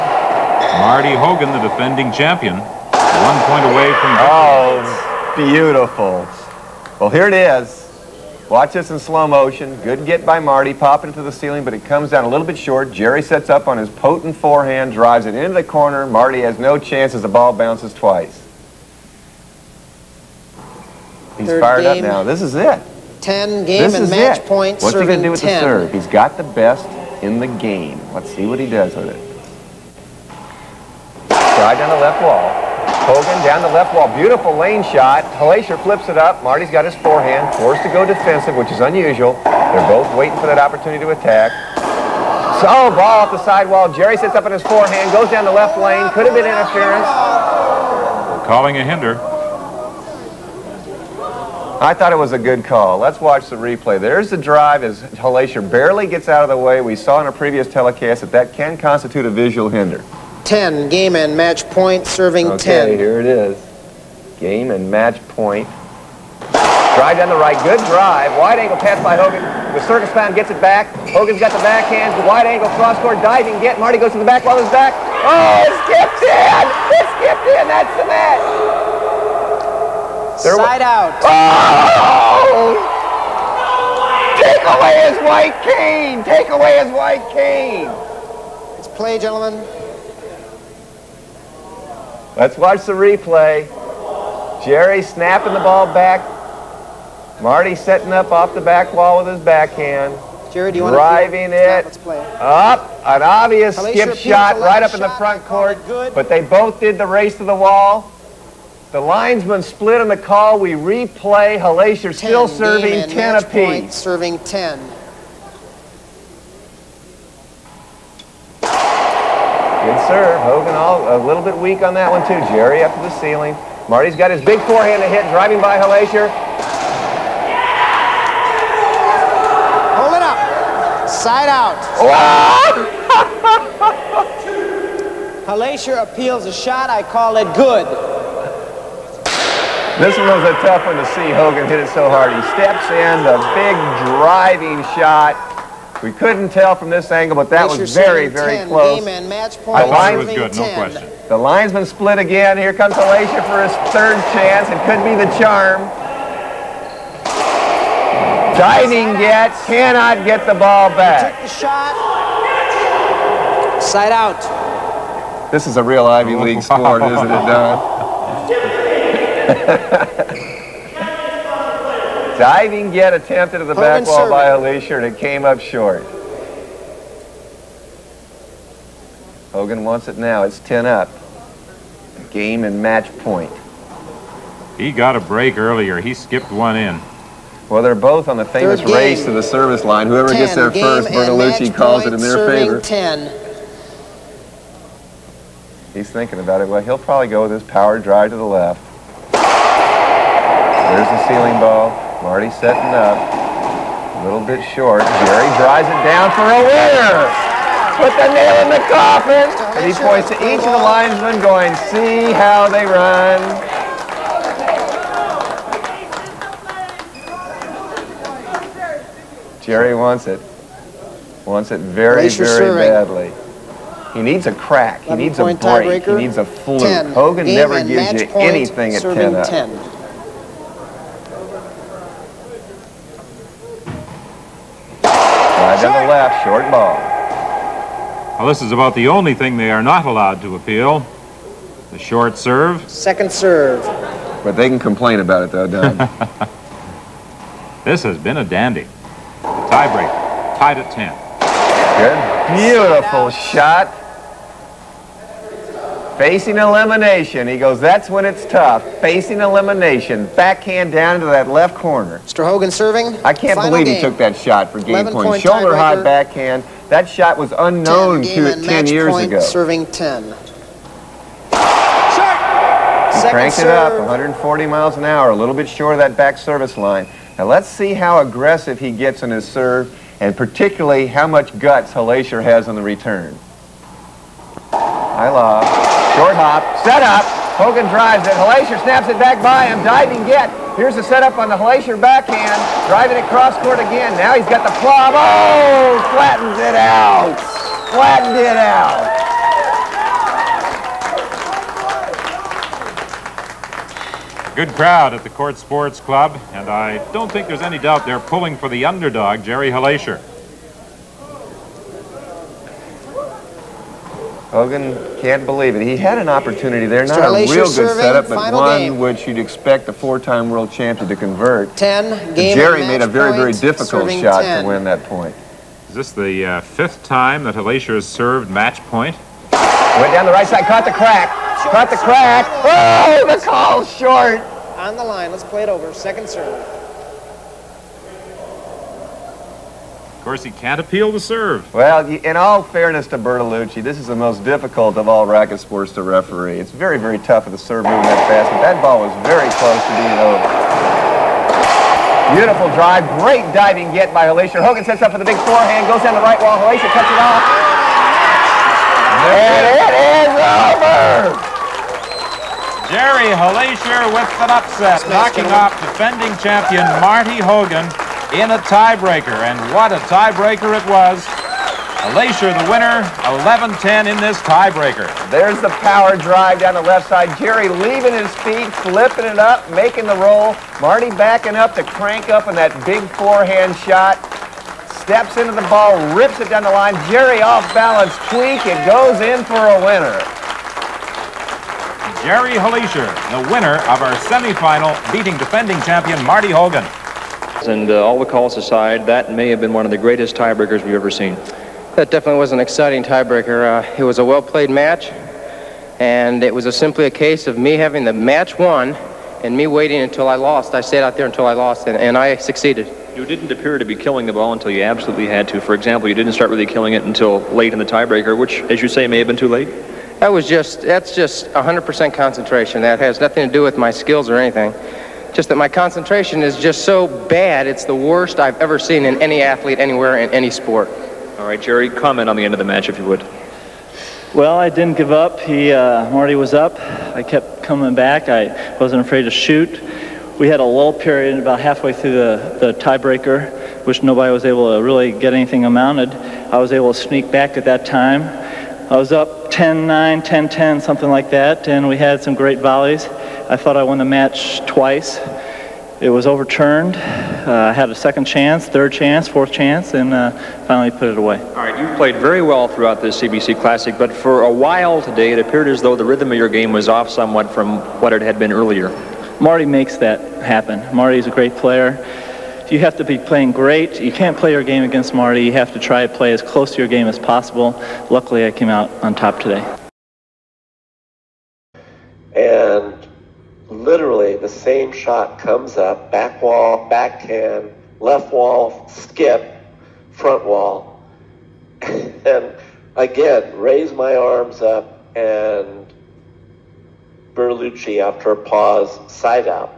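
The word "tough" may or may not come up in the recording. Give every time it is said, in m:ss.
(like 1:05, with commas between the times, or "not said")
2:20, 4:18, 5:47.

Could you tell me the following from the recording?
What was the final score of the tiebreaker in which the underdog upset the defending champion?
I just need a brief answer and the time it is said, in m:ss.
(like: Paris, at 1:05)
11-10, at 6:13.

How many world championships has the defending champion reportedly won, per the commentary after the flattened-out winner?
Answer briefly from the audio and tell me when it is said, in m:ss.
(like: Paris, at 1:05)
4, at 5:19.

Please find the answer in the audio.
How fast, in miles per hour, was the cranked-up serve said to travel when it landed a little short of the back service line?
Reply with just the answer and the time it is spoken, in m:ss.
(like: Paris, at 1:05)
140, at 4:34.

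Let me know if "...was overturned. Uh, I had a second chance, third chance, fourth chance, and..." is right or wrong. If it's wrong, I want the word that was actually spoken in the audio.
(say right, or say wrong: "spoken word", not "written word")
right.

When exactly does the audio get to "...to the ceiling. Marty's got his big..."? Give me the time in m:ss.
2:02.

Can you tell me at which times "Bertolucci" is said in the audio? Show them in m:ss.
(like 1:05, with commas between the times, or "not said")
3:11, 5:43, 8:17.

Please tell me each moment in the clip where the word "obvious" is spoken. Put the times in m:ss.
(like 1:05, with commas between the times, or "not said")
1:43.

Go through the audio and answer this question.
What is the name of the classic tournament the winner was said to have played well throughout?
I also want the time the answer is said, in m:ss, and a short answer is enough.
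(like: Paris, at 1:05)
CBC Classic, at 7:43.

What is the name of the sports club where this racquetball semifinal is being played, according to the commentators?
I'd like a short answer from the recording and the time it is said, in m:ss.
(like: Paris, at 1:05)
Court Sports Club, at 5:05.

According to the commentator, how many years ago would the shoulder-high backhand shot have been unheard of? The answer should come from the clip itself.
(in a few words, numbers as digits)
10.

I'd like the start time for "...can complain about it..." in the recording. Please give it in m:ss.
4:04.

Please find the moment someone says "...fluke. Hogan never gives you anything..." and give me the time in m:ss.
3:46.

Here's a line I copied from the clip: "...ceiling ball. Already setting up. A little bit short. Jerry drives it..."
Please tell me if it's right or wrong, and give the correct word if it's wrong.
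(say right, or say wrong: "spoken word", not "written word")
right.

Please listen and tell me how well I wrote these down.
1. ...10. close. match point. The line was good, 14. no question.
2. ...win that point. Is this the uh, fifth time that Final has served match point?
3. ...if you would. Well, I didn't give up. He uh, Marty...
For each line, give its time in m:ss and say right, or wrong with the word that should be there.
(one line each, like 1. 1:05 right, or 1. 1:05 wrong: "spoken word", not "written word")
1. 2:28 wrong: "10", not "14"
2. 5:24 wrong: "Hilecher", not "Final"
3. 7:12 right.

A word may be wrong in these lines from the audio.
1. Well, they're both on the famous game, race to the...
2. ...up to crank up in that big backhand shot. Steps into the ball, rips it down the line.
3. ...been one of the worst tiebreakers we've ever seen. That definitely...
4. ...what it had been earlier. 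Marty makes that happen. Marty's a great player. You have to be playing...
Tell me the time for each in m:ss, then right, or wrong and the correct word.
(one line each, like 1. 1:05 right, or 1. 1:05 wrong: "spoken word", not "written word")
1. 3:07 right
2. 6:21 wrong: "forehand", not "backhand"
3. 6:39 wrong: "greatest", not "worst"
4. 7:47 right.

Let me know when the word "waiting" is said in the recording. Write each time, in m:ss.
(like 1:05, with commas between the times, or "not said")
0:40, 6:49.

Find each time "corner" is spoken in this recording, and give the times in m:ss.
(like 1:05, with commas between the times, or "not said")
0:15, 4:21.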